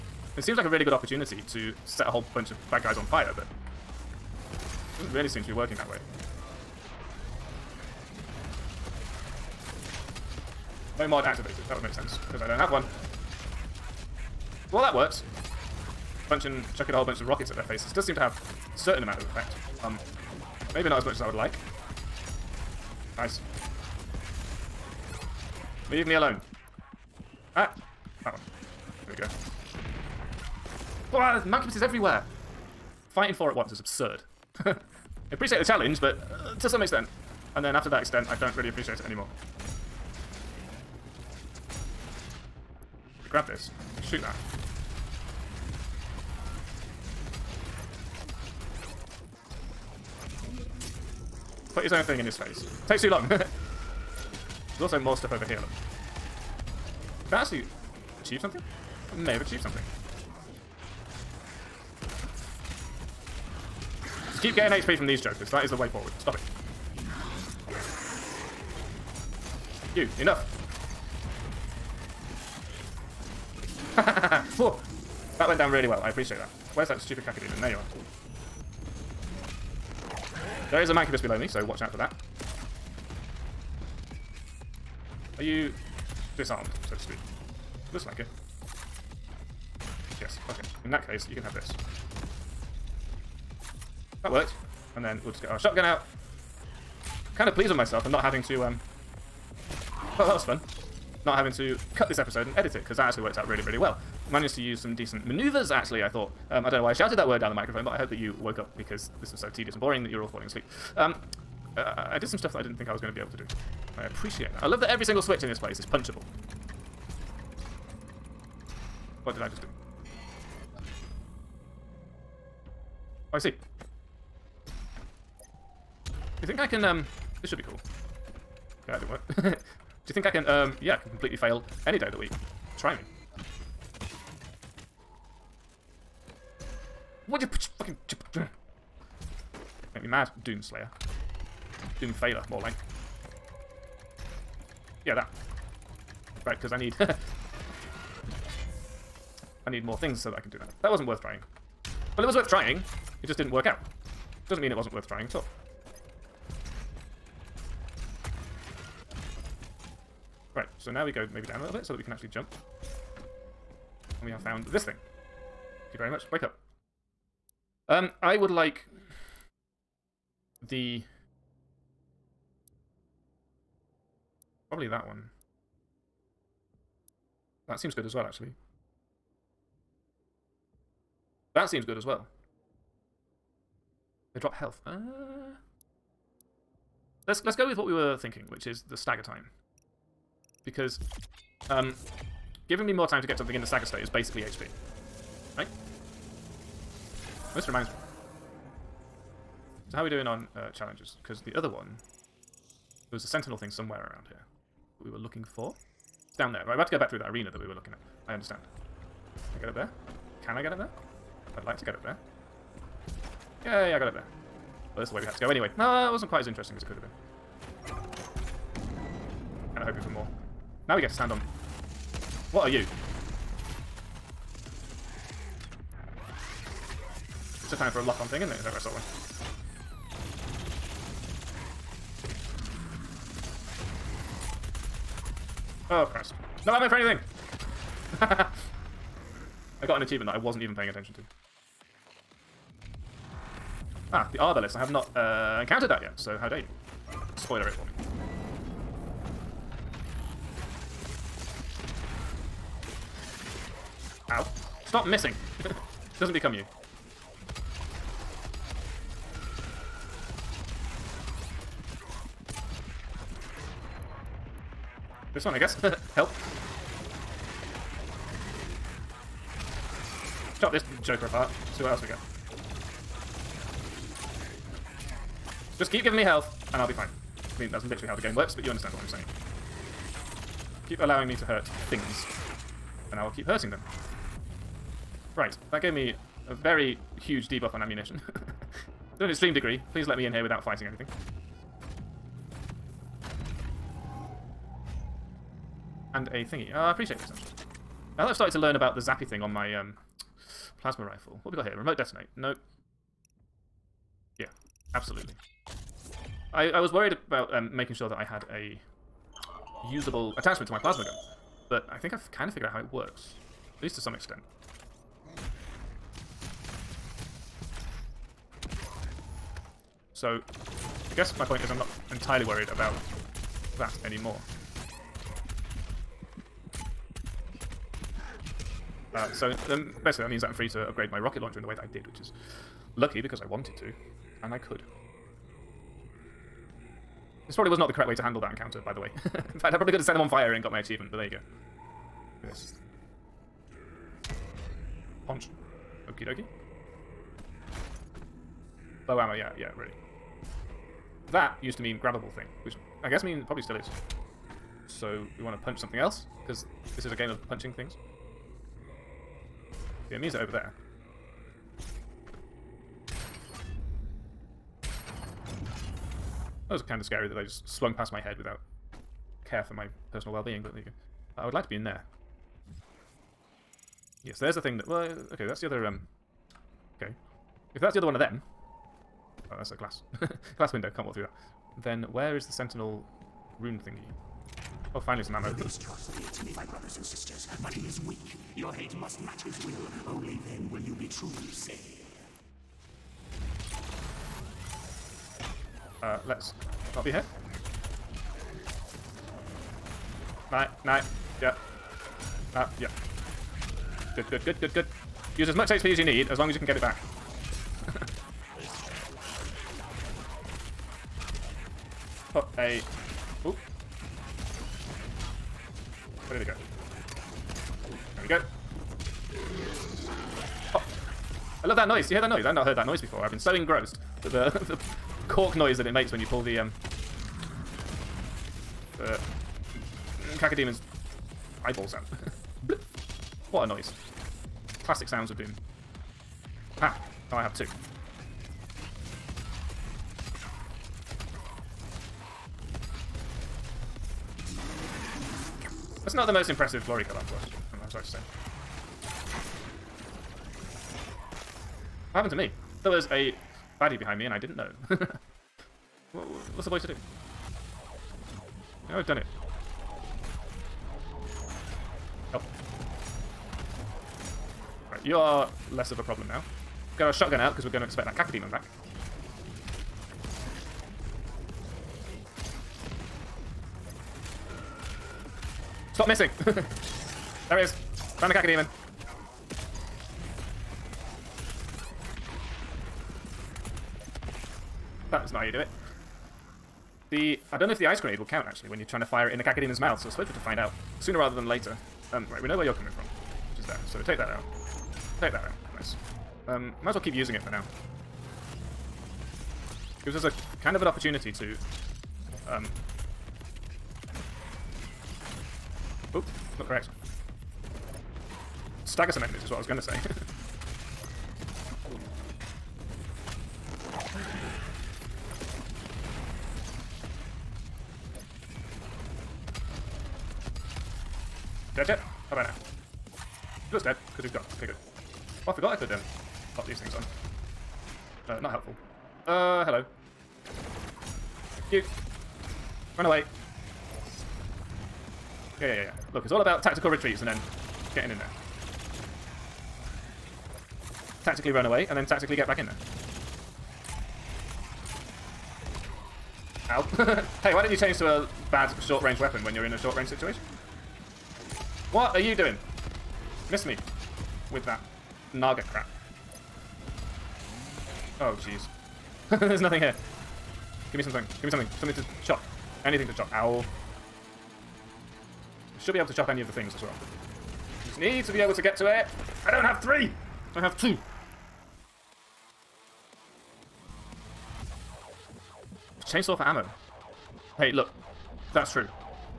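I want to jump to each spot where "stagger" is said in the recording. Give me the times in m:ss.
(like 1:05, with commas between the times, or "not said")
3:08, 3:13, 8:28.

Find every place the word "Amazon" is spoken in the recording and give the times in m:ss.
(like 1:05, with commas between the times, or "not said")
not said.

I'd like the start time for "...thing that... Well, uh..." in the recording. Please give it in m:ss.
6:14.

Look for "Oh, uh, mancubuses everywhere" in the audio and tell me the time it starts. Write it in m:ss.
0:31.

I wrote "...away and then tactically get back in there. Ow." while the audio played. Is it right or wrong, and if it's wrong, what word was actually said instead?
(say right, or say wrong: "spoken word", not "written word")
right.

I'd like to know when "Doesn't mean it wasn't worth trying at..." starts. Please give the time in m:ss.
2:34.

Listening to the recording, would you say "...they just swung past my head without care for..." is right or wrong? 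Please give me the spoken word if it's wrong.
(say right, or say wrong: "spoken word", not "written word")
right.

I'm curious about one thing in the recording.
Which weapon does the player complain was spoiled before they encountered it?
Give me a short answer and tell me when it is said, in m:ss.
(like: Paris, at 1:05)
the Arbalest, at 4:04.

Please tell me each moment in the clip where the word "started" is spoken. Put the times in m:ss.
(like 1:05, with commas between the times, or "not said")
4:58.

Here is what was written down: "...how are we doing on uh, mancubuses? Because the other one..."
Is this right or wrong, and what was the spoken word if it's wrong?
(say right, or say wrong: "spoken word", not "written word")
wrong: "challenges", not "mancubuses".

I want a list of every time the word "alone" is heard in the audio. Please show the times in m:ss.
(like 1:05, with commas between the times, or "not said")
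0:26.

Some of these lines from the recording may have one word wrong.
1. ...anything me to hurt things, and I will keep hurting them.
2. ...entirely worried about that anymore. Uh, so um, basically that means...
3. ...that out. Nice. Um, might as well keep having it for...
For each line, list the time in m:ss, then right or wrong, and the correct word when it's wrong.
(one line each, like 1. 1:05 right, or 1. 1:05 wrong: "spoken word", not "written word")
1. 4:40 wrong: "allowing", not "anything"
2. 5:22 right
3. 8:15 wrong: "using", not "having".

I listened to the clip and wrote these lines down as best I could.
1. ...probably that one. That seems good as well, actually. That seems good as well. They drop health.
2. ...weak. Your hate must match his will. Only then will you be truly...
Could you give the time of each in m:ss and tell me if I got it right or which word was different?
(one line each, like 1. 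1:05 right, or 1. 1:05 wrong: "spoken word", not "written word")
1. 2:54 right
2. 6:28 right.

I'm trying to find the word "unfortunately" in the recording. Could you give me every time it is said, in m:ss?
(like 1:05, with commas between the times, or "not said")
7:27.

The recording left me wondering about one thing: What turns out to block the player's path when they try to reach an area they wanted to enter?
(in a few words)
glass window.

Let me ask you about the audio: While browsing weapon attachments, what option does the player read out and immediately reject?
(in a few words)
Remote detonate.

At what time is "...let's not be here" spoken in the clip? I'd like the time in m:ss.
6:36.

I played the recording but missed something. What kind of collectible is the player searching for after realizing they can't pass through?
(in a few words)
sentinel rune.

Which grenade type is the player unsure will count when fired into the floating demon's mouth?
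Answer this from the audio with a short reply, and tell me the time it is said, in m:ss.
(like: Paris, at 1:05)
ice grenade, at 8:07.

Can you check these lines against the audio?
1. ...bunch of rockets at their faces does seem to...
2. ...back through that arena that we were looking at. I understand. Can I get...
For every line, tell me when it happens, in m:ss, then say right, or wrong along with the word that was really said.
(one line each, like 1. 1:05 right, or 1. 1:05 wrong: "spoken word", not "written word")
1. 0:17 right
2. 3:26 right.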